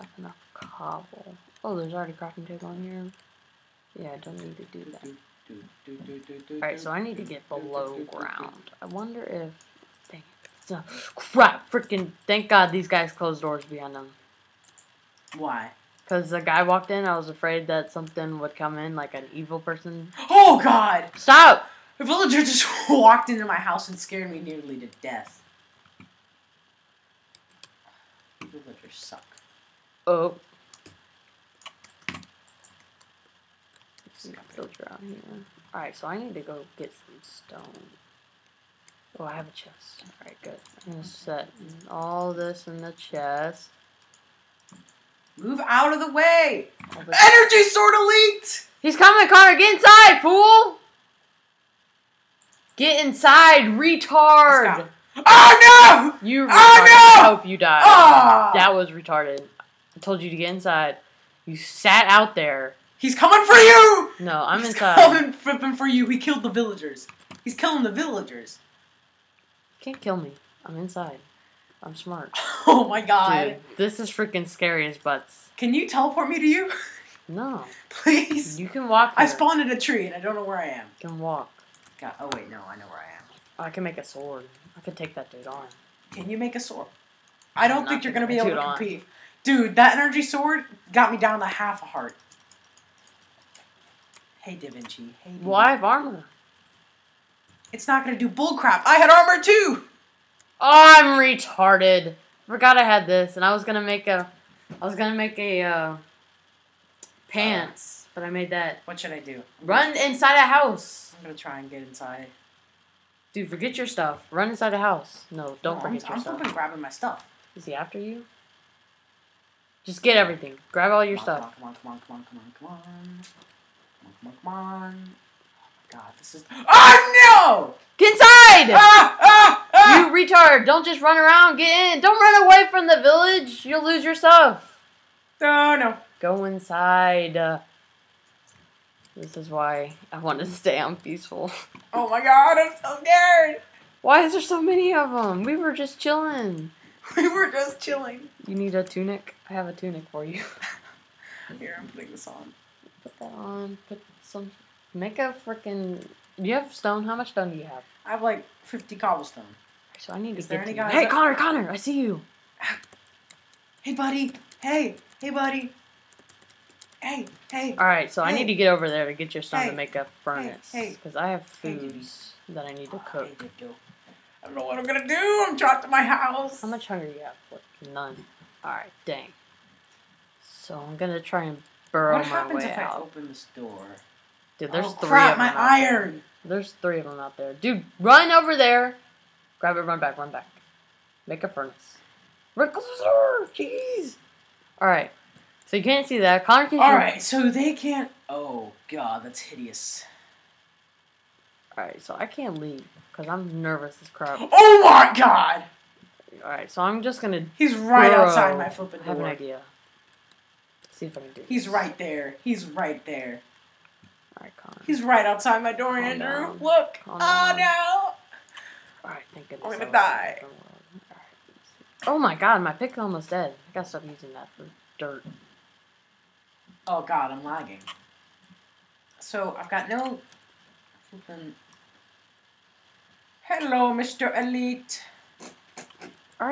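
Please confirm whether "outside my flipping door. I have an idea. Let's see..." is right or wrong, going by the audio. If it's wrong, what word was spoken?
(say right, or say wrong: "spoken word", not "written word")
right.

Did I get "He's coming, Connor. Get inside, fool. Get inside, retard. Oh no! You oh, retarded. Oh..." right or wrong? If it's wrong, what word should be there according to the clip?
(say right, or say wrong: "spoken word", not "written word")
right.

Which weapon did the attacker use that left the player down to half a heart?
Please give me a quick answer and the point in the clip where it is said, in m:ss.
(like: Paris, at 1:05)
energy sword, at 1:29.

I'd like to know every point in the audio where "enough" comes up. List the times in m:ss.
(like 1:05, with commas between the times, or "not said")
0:00.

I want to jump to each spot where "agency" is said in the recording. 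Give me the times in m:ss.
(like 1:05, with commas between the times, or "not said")
not said.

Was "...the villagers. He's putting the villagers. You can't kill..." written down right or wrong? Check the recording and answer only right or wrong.
wrong.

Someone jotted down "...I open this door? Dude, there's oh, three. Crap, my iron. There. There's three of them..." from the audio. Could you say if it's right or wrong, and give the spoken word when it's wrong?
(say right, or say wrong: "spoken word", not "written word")
right.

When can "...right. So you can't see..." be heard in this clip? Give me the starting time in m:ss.
3:14.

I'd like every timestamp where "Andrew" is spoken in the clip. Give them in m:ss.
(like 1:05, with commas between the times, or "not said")
3:36.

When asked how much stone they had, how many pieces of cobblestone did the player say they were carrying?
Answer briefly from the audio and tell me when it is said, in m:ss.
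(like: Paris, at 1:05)
50, at 2:38.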